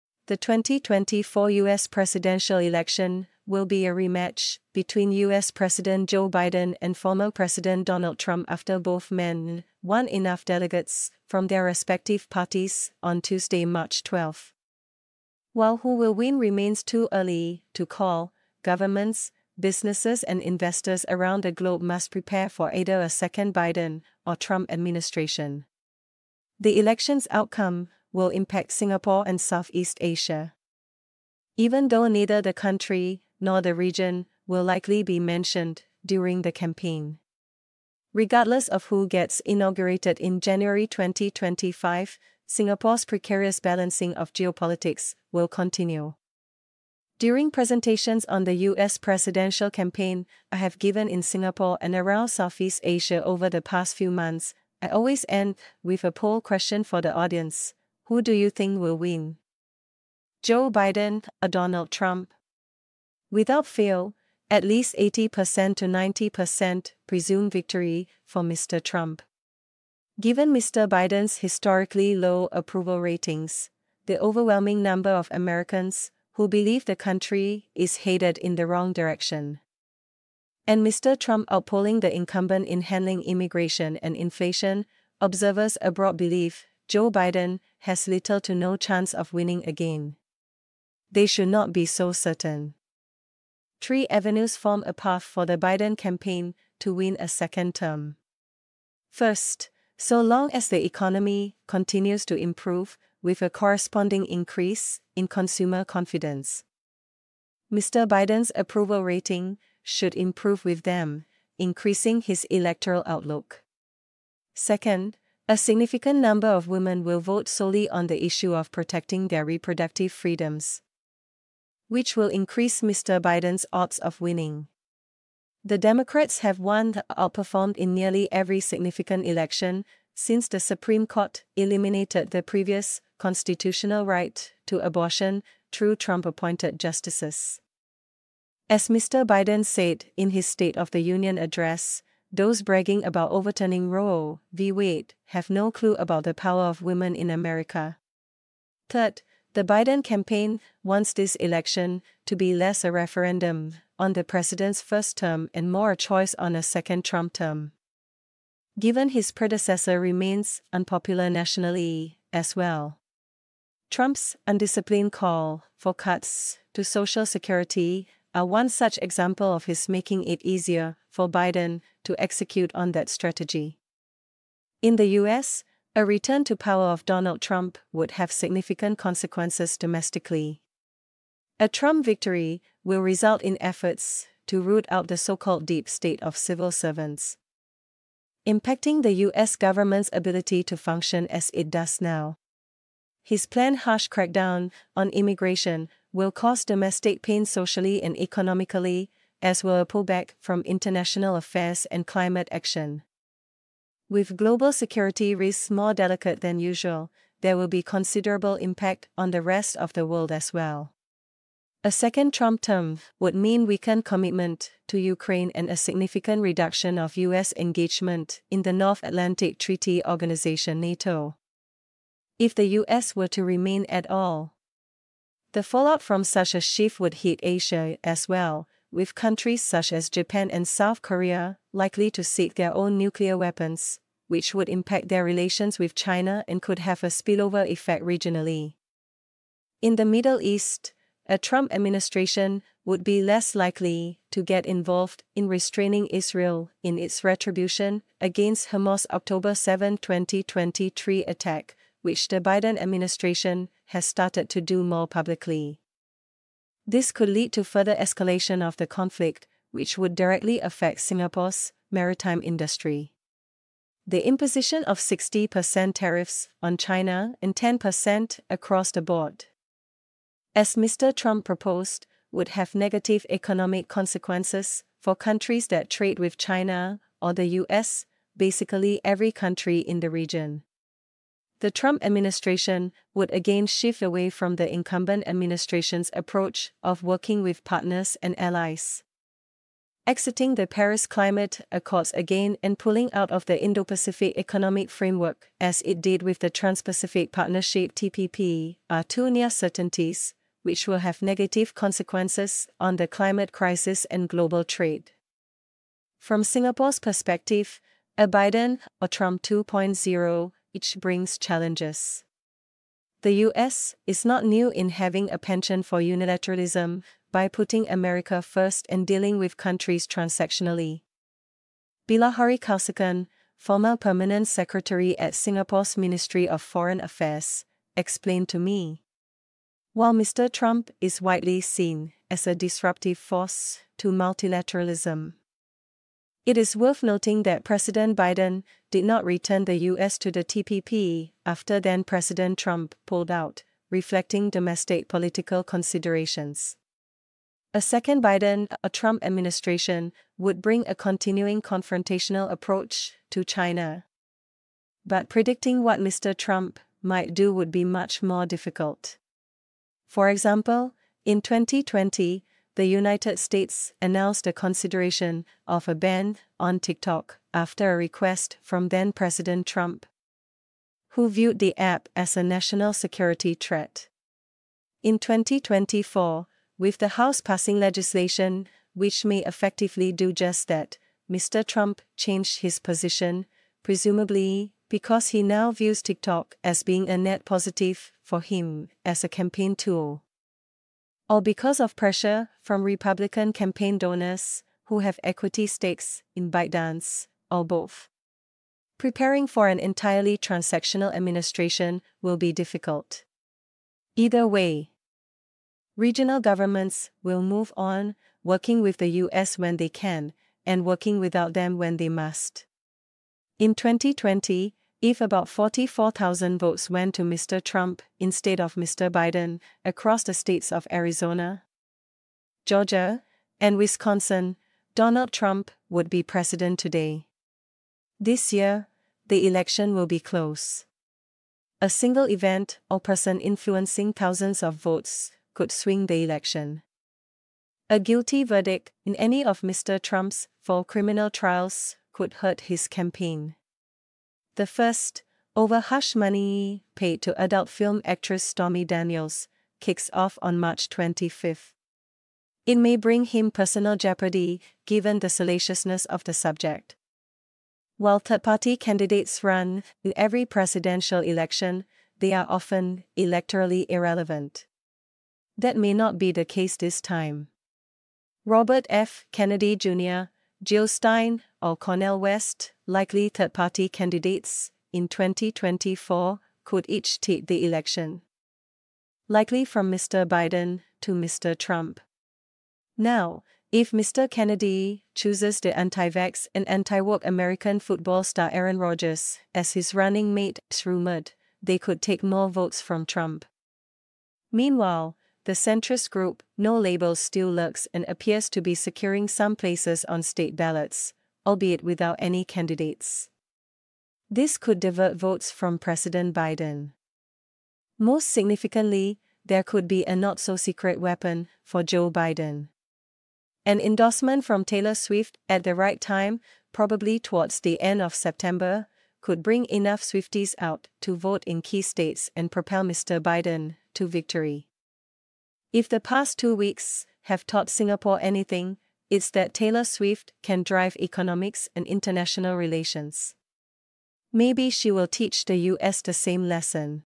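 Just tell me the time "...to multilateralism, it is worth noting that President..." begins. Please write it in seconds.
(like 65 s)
333 s.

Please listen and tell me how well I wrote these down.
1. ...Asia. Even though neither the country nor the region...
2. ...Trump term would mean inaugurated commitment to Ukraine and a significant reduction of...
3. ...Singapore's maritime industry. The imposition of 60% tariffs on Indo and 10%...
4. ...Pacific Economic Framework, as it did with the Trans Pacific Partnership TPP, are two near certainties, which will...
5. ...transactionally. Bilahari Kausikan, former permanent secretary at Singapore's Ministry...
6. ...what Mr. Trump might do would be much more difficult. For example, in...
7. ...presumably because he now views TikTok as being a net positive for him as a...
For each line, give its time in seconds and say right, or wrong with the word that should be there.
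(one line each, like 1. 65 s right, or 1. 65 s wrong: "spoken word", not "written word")
1. 30 s right
2. 212 s wrong: "weakened", not "inaugurated"
3. 261 s wrong: "China", not "Indo"
4. 293 s right
5. 320 s right
6. 355 s right
7. 383 s right.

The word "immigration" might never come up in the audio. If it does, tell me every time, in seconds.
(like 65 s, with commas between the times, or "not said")
83 s, 195 s.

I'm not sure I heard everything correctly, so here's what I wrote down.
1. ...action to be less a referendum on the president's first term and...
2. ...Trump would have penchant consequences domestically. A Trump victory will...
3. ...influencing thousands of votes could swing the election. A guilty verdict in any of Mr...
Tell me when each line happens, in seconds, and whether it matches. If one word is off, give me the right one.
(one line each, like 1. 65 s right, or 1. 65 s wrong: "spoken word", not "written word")
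1. 151 s wrong: "election", not "action"
2. 177 s wrong: "significant", not "penchant"
3. 433 s right.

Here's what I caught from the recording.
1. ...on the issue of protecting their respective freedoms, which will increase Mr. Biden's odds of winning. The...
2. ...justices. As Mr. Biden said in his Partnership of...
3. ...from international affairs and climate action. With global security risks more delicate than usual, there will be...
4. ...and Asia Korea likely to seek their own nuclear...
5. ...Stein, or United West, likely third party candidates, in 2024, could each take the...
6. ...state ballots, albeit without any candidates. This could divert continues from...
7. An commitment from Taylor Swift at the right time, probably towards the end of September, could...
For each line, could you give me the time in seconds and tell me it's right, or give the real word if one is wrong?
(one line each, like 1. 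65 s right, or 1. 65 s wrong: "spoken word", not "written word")
1. 117 s wrong: "reproductive", not "respective"
2. 136 s wrong: "State", not "Partnership"
3. 200 s right
4. 230 s wrong: "South", not "Asia"
5. 470 s wrong: "Cornel", not "United"
6. 500 s wrong: "votes", not "continues"
7. 513 s wrong: "endorsement", not "commitment".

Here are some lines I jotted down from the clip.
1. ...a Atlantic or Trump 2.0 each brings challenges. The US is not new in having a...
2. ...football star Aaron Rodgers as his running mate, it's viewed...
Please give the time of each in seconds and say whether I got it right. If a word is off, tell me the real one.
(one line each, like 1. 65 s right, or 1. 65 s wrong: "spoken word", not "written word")
1. 308 s wrong: "Biden", not "Atlantic"
2. 487 s wrong: "rumored", not "viewed".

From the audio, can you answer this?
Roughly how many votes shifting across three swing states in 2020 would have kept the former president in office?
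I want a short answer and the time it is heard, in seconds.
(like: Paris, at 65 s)
44,000, at 415 s.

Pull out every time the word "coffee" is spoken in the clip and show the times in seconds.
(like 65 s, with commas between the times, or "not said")
not said.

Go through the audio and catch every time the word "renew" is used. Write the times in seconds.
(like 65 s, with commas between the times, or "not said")
not said.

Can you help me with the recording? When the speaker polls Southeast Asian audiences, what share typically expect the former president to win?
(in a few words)
80% to 90%.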